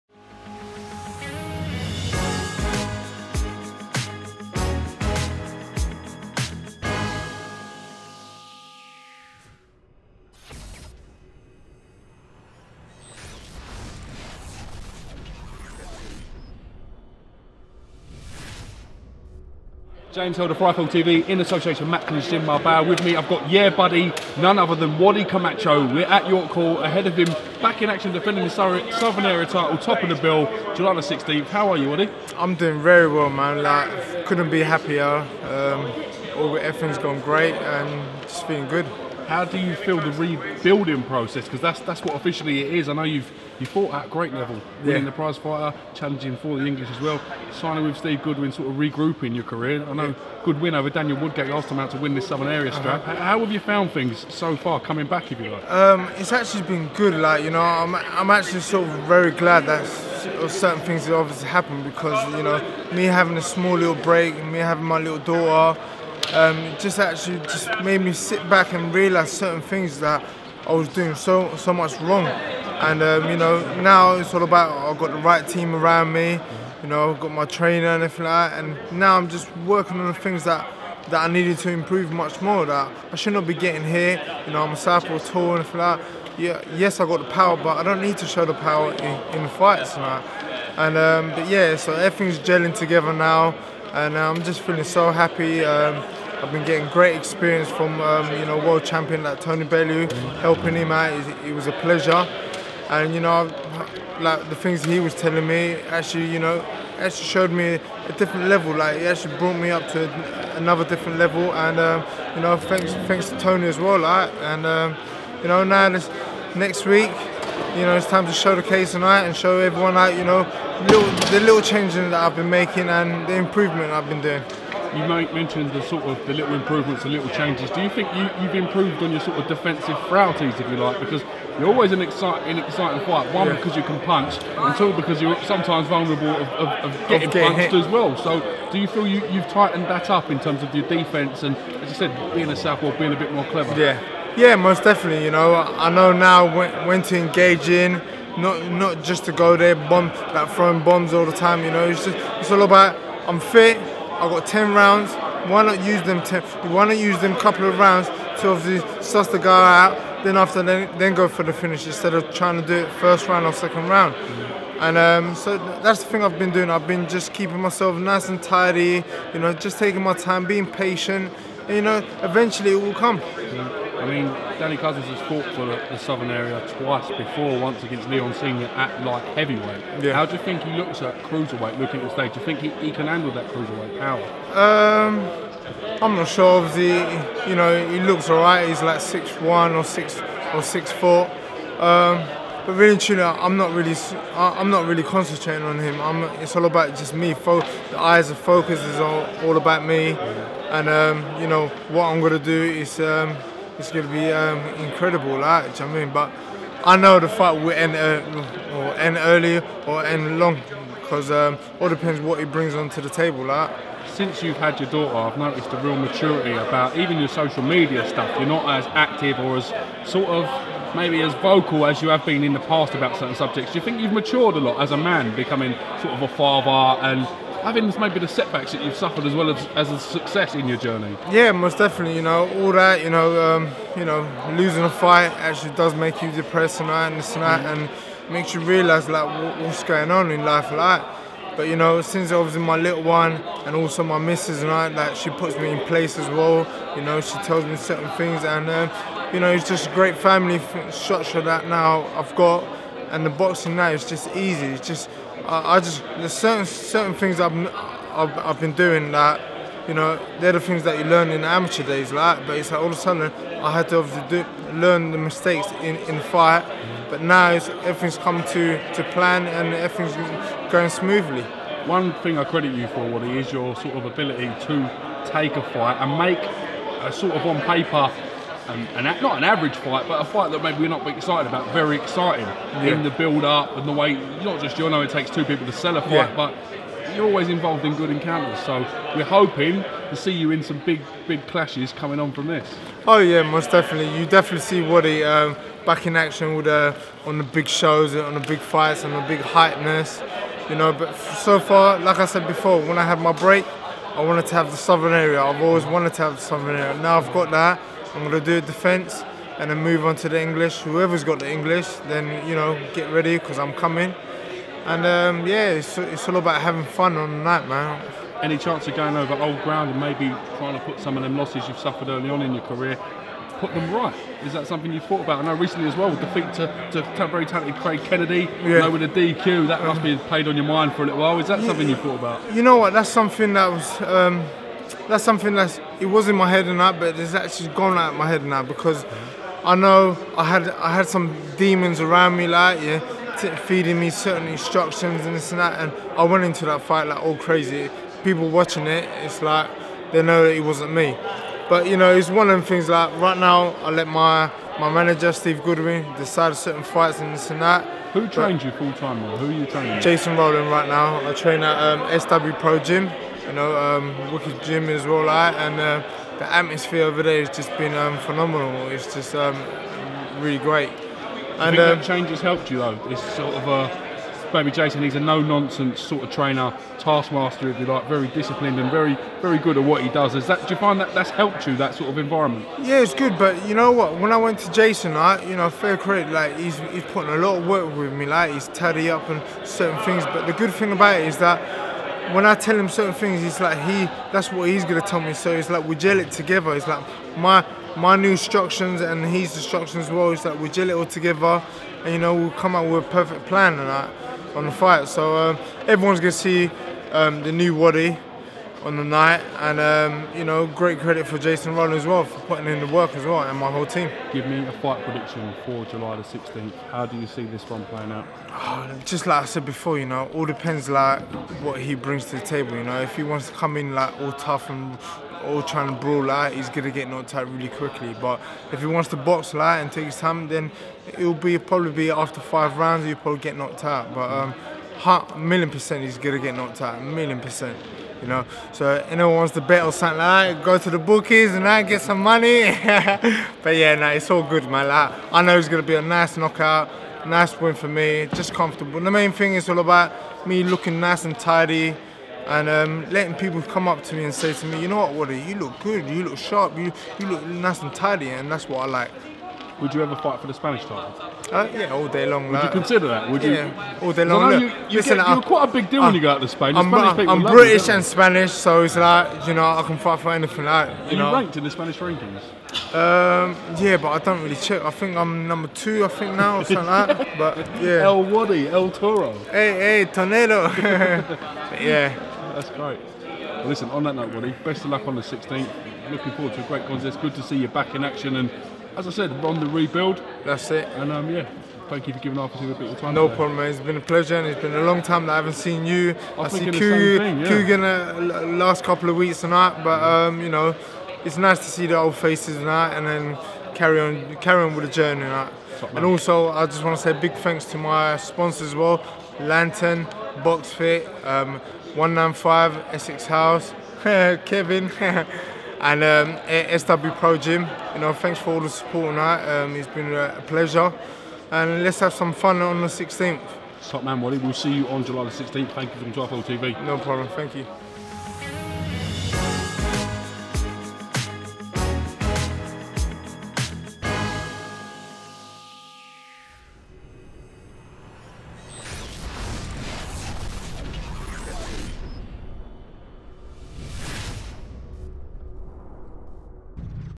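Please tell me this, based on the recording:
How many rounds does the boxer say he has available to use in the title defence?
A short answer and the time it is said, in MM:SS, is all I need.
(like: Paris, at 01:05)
10, at 02:34.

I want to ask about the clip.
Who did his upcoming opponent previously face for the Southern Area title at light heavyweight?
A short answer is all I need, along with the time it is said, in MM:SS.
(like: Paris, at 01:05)
Leon Senior, at 02:58.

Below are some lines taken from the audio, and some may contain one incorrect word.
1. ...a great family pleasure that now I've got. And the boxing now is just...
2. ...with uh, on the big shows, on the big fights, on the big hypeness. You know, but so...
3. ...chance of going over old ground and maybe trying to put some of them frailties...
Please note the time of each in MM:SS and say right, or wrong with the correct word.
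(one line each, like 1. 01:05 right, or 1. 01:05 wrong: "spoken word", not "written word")
1. 04:09 wrong: "structure", not "pleasure"
2. 04:56 right
3. 05:18 wrong: "losses", not "frailties".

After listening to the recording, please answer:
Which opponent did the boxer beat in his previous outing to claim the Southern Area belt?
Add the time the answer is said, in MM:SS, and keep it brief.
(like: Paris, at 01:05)
Daniel Woodgate, at 00:50.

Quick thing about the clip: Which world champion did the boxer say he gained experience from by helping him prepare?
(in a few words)
Tony Bellew.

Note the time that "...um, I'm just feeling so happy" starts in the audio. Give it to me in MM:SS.
01:34.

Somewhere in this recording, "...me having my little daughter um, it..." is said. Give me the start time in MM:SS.
01:04.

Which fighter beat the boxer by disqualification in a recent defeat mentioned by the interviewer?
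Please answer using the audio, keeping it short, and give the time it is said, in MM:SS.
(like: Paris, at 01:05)
Craig Kennedy, at 05:27.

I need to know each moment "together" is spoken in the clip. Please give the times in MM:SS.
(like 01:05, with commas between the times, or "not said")
01:32, 06:36, 06:41.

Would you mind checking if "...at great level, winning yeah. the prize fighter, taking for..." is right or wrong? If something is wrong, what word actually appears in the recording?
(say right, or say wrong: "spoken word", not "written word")
wrong: "challenging", not "taking".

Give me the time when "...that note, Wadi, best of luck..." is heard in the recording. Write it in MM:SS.
08:04.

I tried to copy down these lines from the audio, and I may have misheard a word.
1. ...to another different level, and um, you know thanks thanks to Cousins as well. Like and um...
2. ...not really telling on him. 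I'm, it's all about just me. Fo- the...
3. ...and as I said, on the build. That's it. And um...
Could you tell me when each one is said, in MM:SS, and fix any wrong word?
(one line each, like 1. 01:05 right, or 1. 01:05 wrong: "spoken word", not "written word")
1. 01:49 wrong: "Tony", not "Cousins"
2. 03:14 wrong: "concentrating", not "telling"
3. 08:08 wrong: "rebuild", not "build".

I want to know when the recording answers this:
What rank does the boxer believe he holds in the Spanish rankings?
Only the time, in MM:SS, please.
07:55.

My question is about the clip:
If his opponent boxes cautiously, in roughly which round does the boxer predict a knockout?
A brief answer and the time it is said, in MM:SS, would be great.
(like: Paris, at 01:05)
5, at 07:12.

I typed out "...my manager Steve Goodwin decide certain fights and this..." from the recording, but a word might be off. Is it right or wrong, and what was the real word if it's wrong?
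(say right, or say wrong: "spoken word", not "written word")
right.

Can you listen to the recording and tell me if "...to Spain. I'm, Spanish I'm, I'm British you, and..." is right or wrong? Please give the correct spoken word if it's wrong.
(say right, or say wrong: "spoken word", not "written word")
right.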